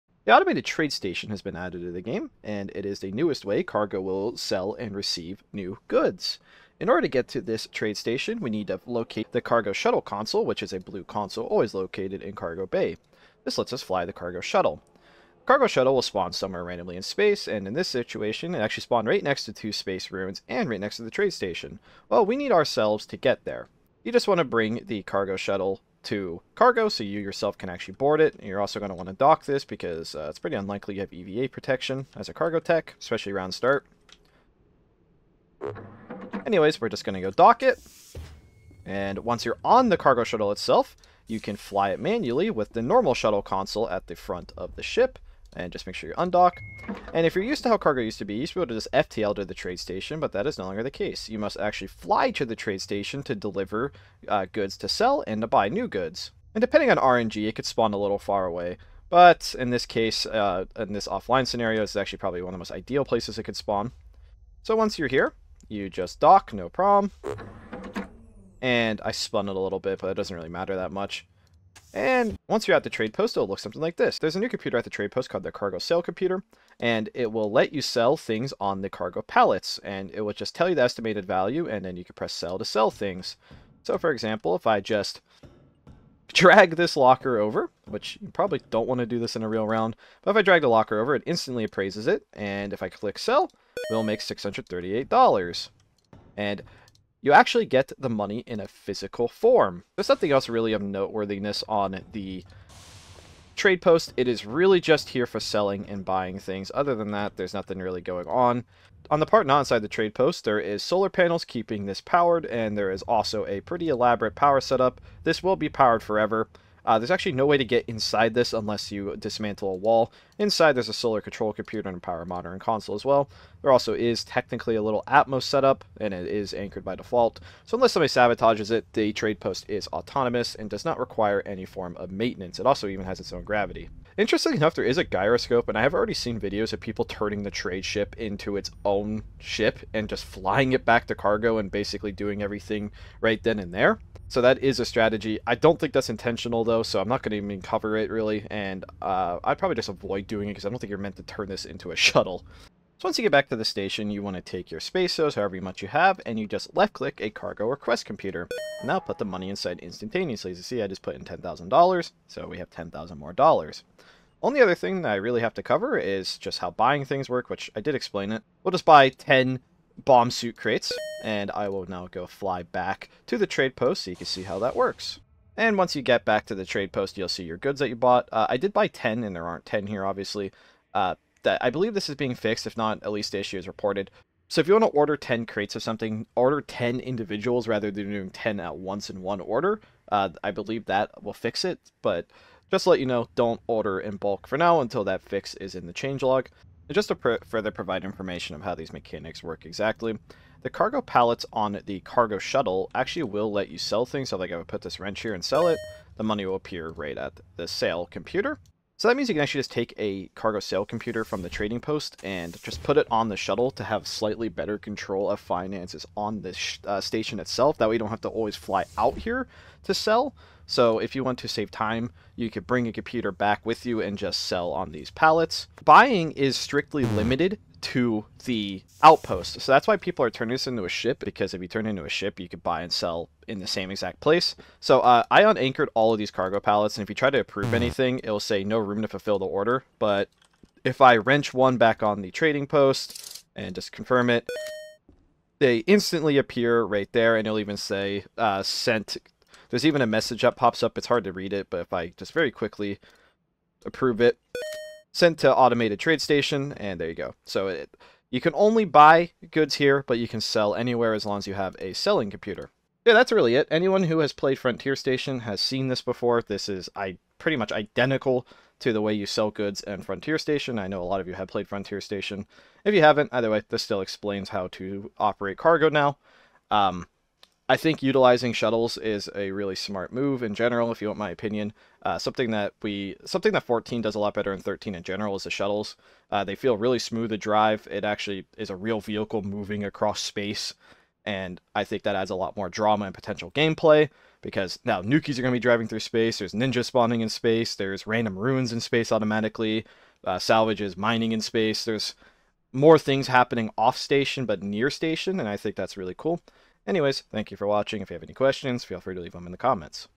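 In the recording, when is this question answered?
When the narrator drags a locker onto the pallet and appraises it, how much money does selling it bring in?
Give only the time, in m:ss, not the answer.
1:34.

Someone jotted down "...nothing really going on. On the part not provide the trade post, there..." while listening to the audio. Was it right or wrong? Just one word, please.
wrong.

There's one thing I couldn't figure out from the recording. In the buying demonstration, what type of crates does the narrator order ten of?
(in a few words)
Bomb suit crates.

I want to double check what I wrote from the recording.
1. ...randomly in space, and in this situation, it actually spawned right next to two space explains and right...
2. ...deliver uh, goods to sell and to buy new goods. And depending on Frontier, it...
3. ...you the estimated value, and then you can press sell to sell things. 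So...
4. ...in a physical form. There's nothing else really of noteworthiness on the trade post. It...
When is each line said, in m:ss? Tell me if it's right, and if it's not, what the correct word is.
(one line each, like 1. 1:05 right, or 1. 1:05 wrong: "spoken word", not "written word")
1. 0:16 wrong: "ruins", not "explains"
2. 0:53 wrong: "RNG", not "Frontier"
3. 1:20 right
4. 1:38 right.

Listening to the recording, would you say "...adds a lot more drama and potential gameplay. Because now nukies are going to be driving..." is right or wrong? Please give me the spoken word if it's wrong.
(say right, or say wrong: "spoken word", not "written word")
right.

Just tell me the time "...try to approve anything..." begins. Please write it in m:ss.
3:57.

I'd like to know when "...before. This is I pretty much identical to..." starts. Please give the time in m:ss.
4:26.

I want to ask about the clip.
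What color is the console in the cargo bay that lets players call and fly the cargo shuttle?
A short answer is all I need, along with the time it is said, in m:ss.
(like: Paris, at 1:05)
Blue, at 0:10.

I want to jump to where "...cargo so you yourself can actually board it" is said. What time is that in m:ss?
0:26.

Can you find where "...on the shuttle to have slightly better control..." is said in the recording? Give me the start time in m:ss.
3:33.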